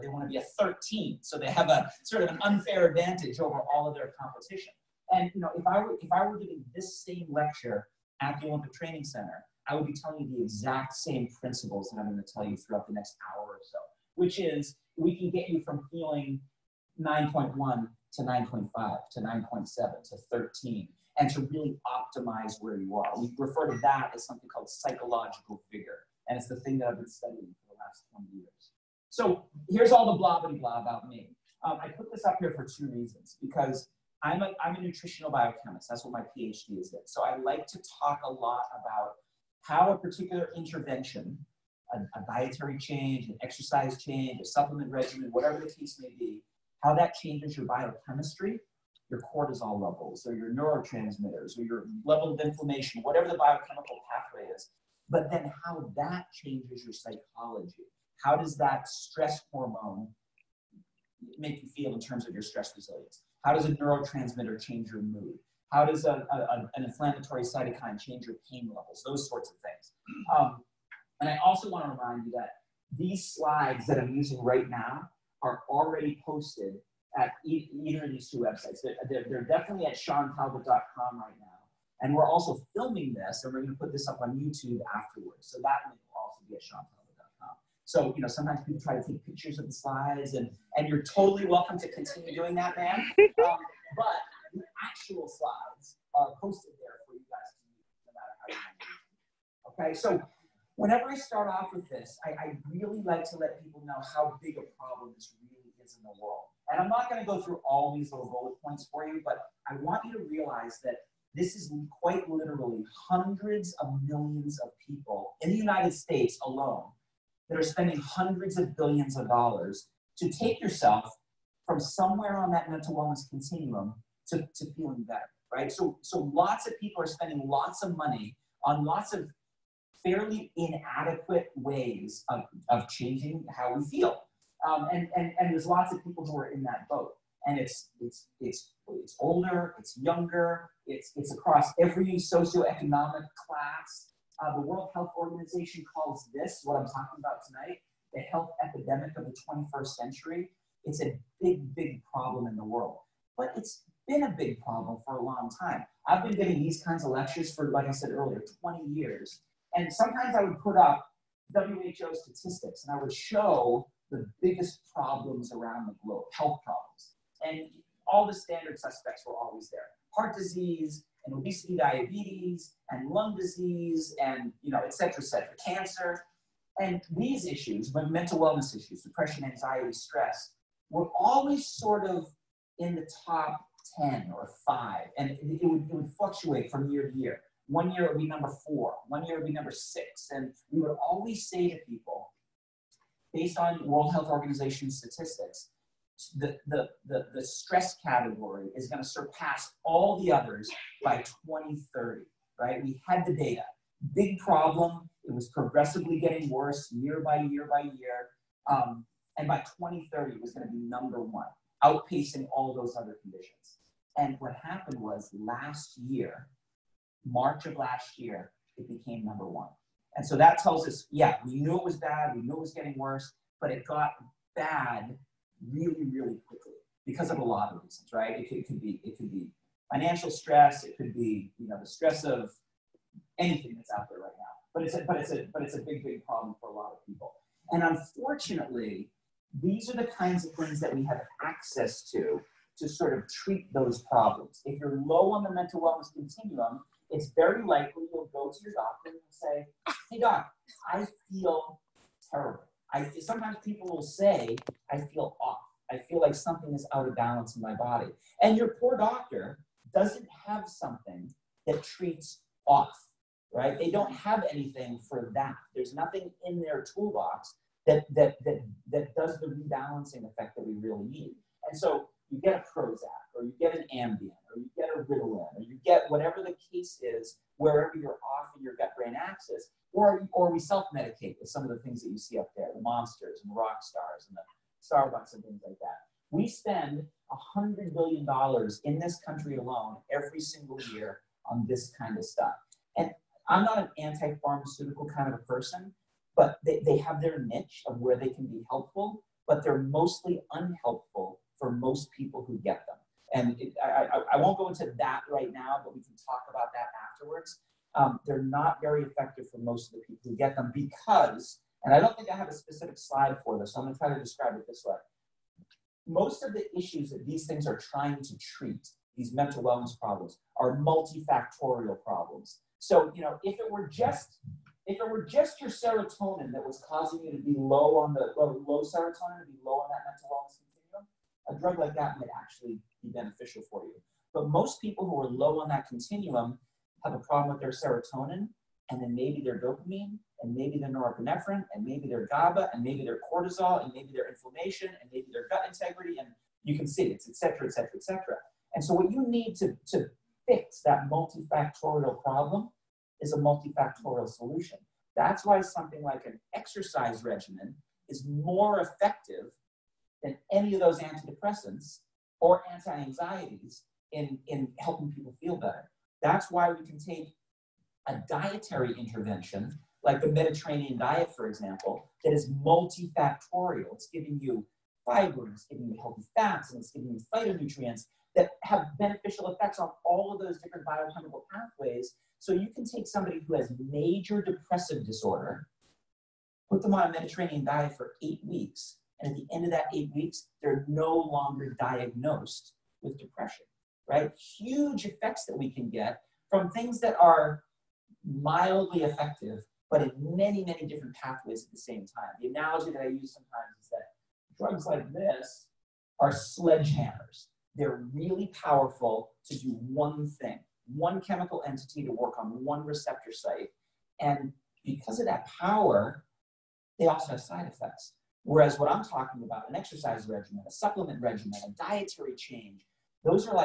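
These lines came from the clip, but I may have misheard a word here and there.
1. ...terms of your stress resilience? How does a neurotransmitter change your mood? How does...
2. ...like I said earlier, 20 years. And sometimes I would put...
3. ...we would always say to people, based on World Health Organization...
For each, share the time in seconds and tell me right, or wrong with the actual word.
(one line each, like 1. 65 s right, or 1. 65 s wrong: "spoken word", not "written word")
1. 62 s right
2. 157 s right
3. 190 s right.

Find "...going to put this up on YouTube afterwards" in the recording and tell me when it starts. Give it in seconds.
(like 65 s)
83 s.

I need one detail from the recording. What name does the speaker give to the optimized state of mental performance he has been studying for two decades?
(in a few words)
Psychological vigor.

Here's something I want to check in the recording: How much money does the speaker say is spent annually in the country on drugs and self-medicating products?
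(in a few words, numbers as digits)
$100 billion.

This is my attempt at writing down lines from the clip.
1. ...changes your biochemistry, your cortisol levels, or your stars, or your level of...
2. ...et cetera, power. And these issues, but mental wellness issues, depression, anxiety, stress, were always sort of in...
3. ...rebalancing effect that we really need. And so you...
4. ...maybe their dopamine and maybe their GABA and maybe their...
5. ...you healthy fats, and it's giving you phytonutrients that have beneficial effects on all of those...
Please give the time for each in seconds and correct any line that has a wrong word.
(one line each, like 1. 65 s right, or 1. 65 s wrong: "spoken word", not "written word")
1. 47 s wrong: "neurotransmitters", not "stars"
2. 175 s wrong: "cancer", not "power"
3. 269 s right
4. 340 s wrong: "norepinephrine", not "dopamine"
5. 375 s right.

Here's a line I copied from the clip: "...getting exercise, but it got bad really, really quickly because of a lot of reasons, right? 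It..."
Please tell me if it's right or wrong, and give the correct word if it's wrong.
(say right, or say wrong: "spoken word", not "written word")
wrong: "worse", not "exercise".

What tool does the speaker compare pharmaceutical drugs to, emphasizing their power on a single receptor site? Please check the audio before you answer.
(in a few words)
Sledgehammers.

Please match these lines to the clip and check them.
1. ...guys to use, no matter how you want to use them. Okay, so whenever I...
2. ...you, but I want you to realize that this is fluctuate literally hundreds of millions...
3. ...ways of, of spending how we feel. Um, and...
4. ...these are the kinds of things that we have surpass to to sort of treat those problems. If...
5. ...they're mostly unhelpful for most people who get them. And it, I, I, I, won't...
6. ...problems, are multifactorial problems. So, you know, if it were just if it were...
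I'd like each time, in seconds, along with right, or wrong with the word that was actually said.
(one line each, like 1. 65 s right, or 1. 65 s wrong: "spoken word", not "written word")
1. 97 s right
2. 109 s wrong: "quite", not "fluctuate"
3. 131 s wrong: "changing", not "spending"
4. 239 s wrong: "access", not "surpass"
5. 299 s right
6. 319 s right.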